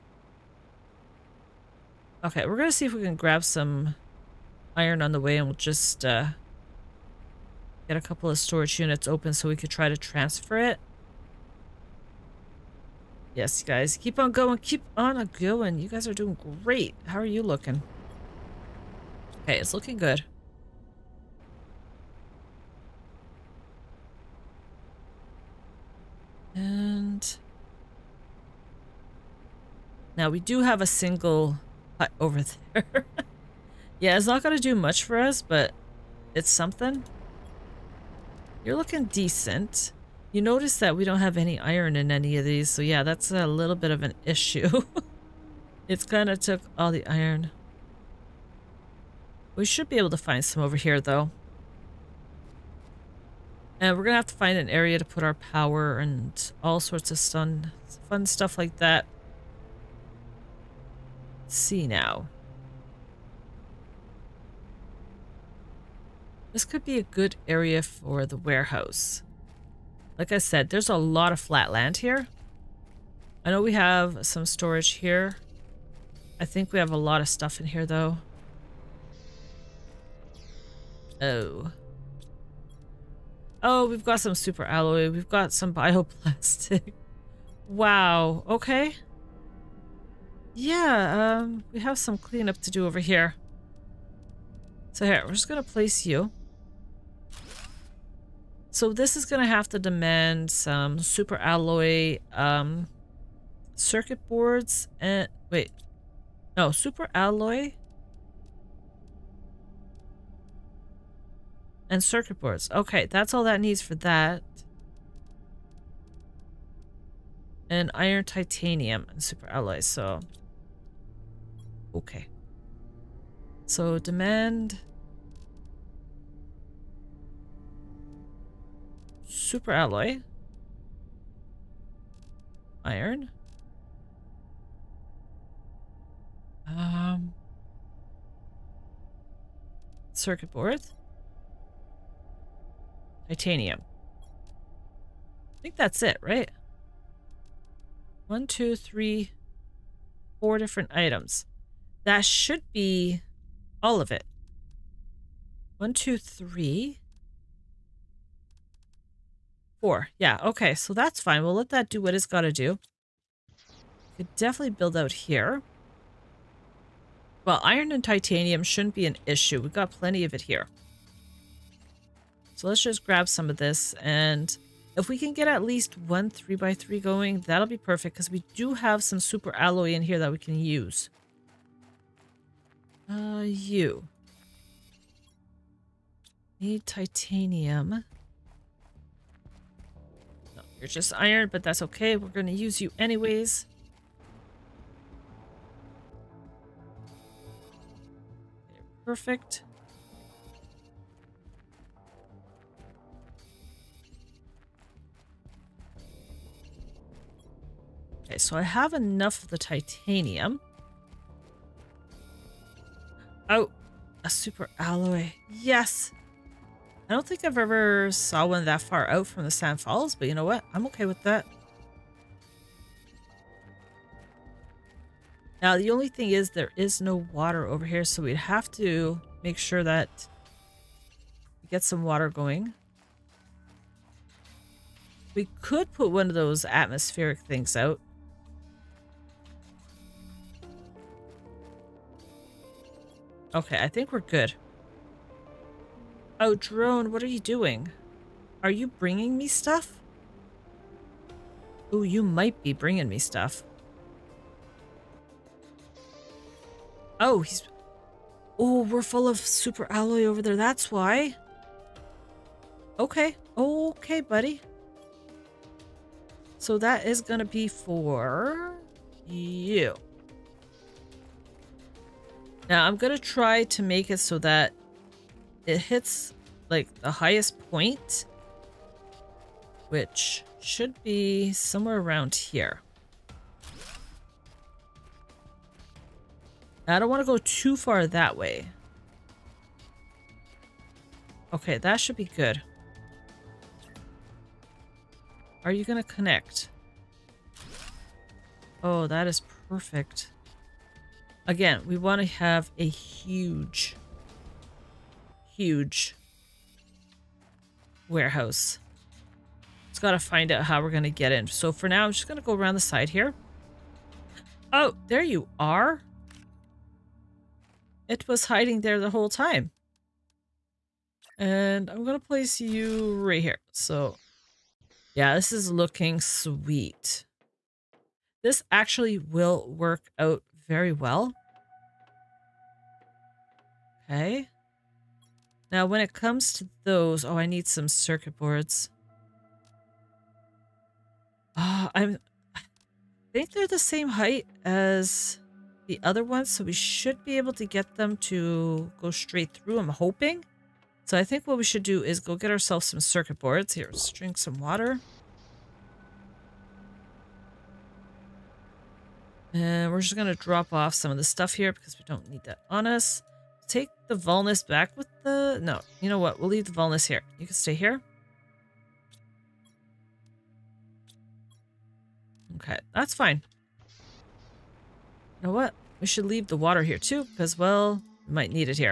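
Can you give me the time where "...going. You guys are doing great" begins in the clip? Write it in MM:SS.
00:15.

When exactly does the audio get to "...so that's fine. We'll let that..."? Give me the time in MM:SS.
02:40.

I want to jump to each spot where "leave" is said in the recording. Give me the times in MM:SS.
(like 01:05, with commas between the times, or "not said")
06:06, 06:16.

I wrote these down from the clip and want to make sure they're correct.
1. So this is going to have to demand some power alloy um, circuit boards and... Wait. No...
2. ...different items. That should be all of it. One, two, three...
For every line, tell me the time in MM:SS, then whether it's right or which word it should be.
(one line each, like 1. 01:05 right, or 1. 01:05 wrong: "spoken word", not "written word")
1. 01:38 wrong: "super", not "power"
2. 02:30 right.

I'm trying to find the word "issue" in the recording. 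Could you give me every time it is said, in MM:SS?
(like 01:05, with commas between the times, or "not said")
00:44, 02:49.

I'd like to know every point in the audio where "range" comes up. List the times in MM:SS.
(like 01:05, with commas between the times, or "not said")
not said.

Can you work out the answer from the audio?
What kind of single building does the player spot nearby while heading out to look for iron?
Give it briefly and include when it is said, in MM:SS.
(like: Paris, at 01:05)
hut, at 00:31.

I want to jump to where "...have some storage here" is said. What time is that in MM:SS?
01:13.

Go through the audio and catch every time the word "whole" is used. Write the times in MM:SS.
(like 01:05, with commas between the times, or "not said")
05:19.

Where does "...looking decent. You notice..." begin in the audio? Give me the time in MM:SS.
00:38.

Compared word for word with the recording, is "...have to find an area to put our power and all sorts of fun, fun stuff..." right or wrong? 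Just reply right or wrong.
right.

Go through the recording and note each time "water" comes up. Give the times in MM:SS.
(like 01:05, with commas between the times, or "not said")
03:47, 03:52, 05:54, 06:16.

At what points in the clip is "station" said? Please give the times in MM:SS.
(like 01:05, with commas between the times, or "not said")
not said.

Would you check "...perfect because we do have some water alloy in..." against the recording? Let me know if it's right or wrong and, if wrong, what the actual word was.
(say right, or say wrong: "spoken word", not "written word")
wrong: "super", not "water".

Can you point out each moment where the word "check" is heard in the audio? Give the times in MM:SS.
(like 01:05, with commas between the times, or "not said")
not said.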